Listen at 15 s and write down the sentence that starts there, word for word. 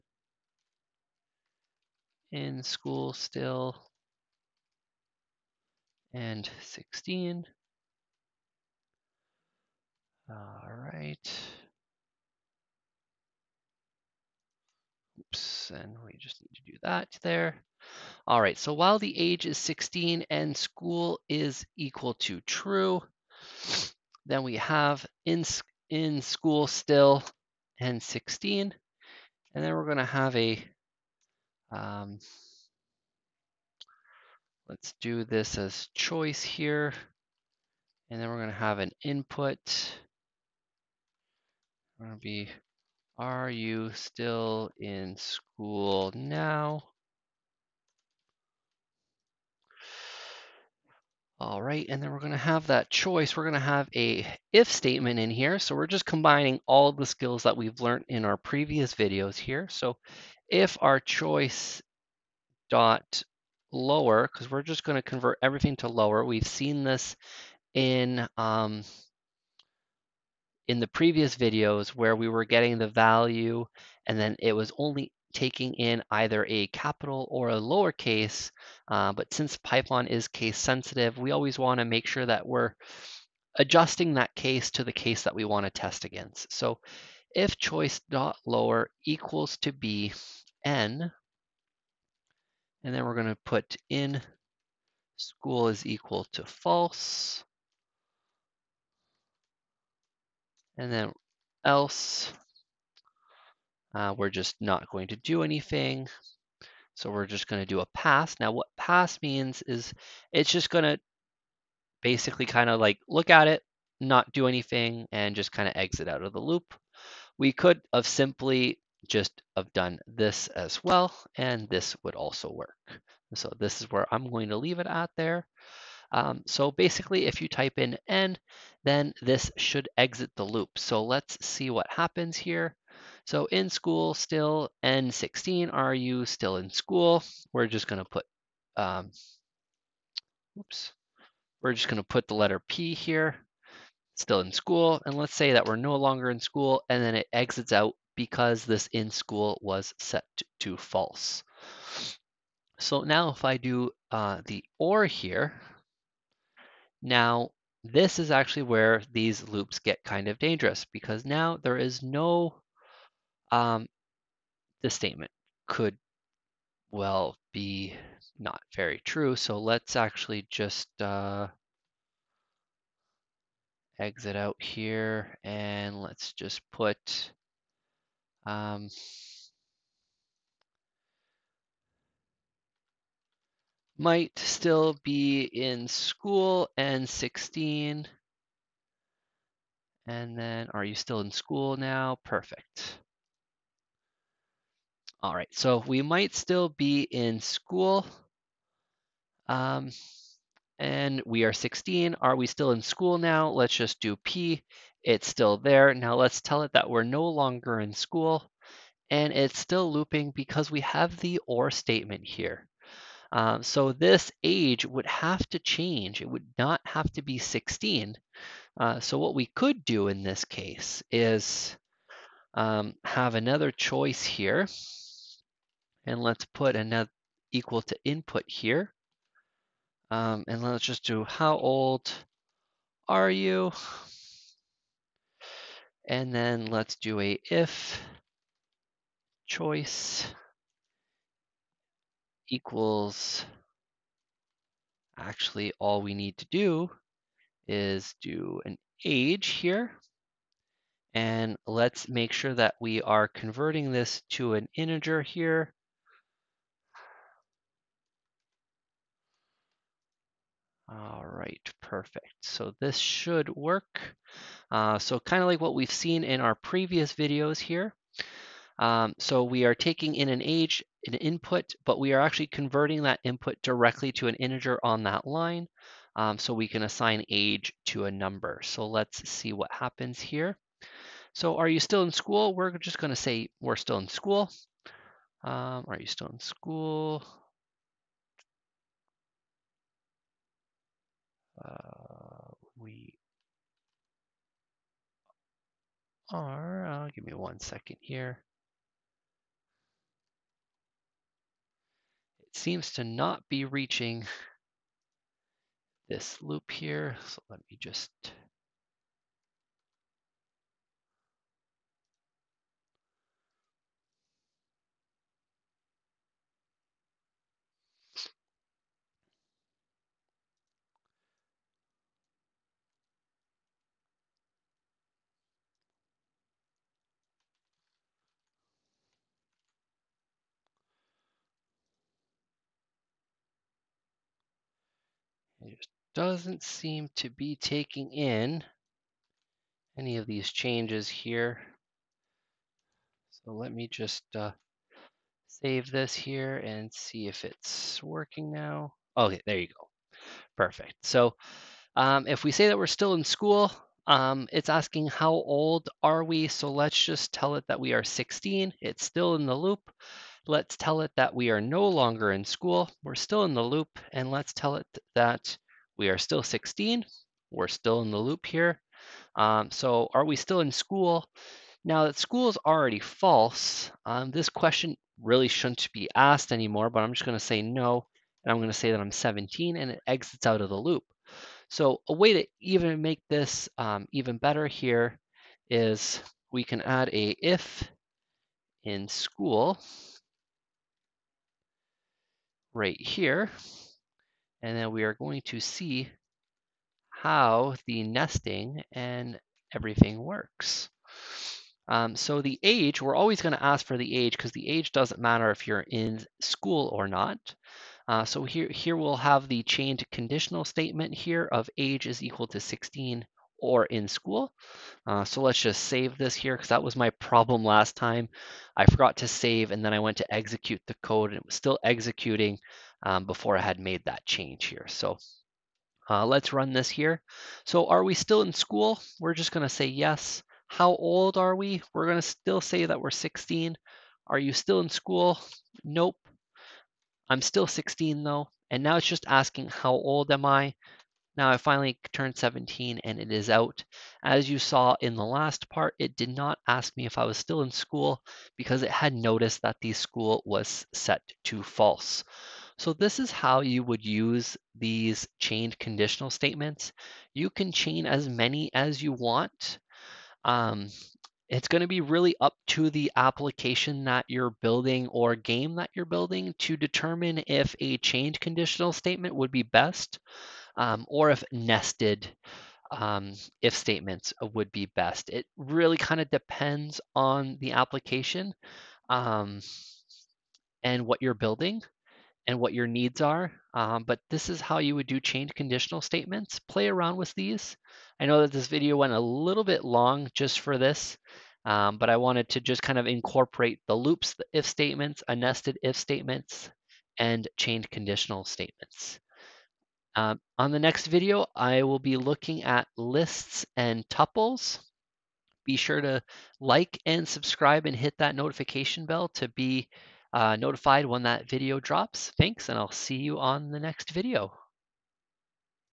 Oops, and we just need to do that there.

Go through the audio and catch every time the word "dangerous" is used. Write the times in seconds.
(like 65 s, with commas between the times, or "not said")
160 s.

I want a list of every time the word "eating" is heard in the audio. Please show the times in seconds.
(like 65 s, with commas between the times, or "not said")
not said.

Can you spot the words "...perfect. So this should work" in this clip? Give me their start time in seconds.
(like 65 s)
261 s.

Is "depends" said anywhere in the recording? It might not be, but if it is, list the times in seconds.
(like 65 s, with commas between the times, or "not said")
476 s.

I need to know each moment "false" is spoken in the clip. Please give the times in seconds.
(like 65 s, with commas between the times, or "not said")
96 s, 150 s, 372 s, 451 s.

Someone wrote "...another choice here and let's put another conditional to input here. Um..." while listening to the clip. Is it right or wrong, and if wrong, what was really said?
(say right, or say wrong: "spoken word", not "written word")
wrong: "equal", not "conditional".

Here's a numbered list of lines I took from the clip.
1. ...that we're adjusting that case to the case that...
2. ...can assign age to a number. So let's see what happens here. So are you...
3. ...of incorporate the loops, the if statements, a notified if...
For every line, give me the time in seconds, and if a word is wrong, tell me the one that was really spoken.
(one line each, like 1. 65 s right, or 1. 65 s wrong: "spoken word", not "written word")
1. 82 s right
2. 276 s right
3. 492 s wrong: "nested", not "notified".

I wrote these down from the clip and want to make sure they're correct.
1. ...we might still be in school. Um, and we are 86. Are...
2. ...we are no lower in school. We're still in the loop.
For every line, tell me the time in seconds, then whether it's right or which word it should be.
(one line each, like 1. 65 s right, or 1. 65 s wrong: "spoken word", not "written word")
1. 195 s wrong: "16", not "86"
2. 361 s wrong: "longer", not "lower".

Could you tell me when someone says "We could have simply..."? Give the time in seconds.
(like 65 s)
117 s.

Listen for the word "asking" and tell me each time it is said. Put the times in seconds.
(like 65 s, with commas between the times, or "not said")
354 s, 439 s.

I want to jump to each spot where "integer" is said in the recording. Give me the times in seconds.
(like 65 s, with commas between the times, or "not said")
254 s, 274 s.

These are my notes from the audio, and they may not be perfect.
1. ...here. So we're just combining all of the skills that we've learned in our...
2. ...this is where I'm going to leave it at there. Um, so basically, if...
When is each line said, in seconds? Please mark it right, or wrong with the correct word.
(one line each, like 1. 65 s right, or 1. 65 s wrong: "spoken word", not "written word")
1. 55 s right
2. 123 s right.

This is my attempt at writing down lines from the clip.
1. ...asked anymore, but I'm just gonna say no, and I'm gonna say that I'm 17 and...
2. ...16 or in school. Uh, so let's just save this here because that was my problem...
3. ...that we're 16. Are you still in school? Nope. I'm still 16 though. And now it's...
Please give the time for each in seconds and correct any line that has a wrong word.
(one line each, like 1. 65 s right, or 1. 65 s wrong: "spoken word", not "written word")
1. 376 s right
2. 412 s right
3. 432 s right.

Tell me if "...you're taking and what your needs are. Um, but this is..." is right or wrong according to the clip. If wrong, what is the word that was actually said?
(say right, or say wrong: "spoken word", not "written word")
wrong: "building", not "taking".